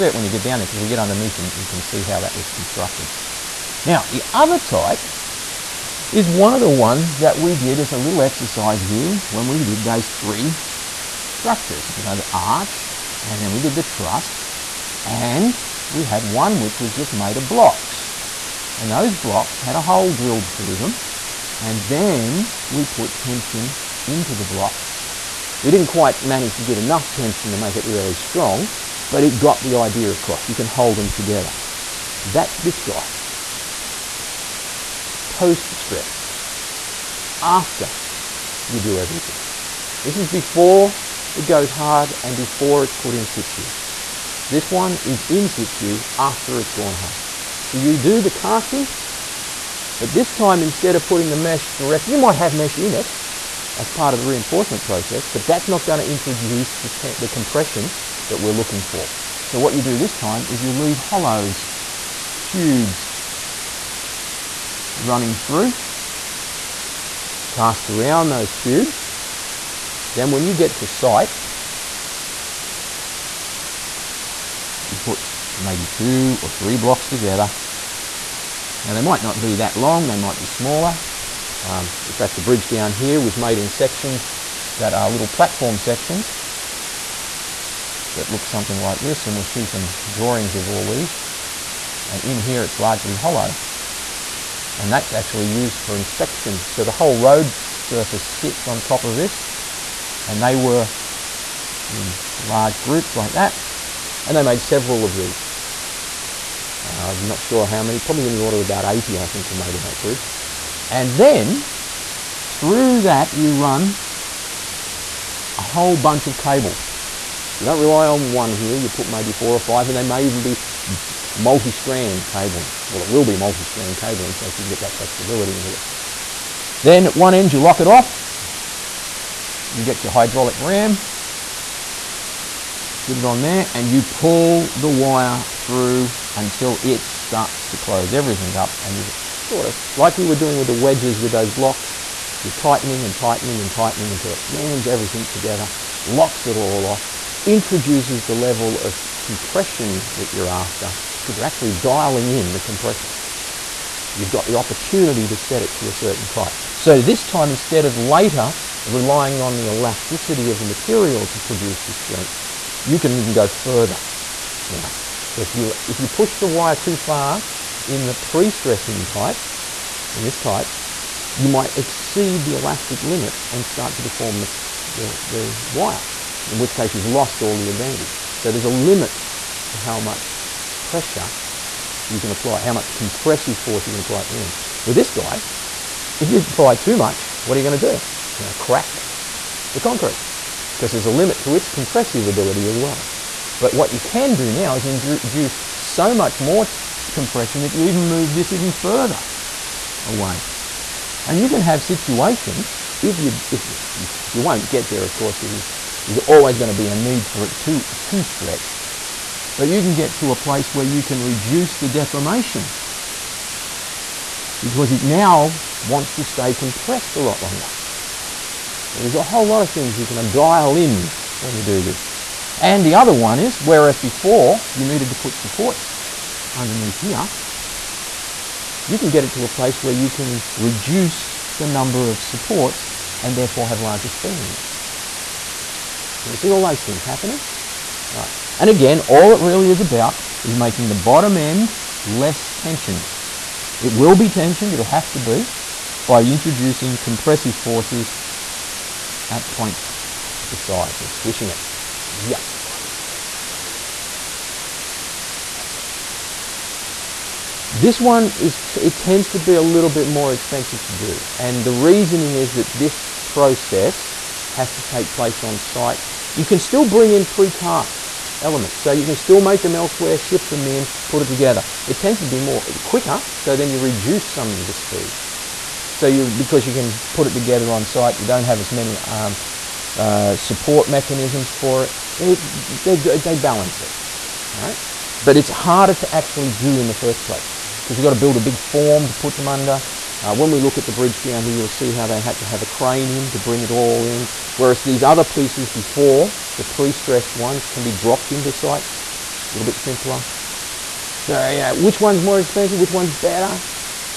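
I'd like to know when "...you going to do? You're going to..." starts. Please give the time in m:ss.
3:07.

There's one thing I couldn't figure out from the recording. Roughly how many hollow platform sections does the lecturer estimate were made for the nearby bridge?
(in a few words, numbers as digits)
80.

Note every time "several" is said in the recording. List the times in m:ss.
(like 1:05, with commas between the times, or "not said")
1:44.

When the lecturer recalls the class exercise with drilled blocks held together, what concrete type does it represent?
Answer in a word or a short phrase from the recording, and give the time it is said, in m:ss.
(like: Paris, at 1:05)
Post stressed, at 0:35.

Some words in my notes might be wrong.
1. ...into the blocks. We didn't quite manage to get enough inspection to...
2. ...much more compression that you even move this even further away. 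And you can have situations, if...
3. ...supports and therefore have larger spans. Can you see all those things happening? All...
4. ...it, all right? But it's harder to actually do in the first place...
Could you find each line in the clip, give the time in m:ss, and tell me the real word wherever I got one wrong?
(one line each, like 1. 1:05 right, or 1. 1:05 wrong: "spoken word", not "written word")
1. 0:24 wrong: "tension", not "inspection"
2. 3:16 right
3. 3:52 right
4. 4:43 right.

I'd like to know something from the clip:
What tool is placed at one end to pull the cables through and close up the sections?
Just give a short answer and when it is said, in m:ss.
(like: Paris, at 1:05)
Hydraulic ram, at 2:10.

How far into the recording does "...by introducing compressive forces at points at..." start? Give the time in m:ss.
4:06.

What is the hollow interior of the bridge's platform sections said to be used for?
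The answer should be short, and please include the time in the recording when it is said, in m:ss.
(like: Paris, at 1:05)
Inspection, at 1:35.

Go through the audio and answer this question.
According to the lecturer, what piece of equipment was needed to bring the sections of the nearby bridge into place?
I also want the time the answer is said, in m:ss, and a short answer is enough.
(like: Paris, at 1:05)
A crane, at 4:52.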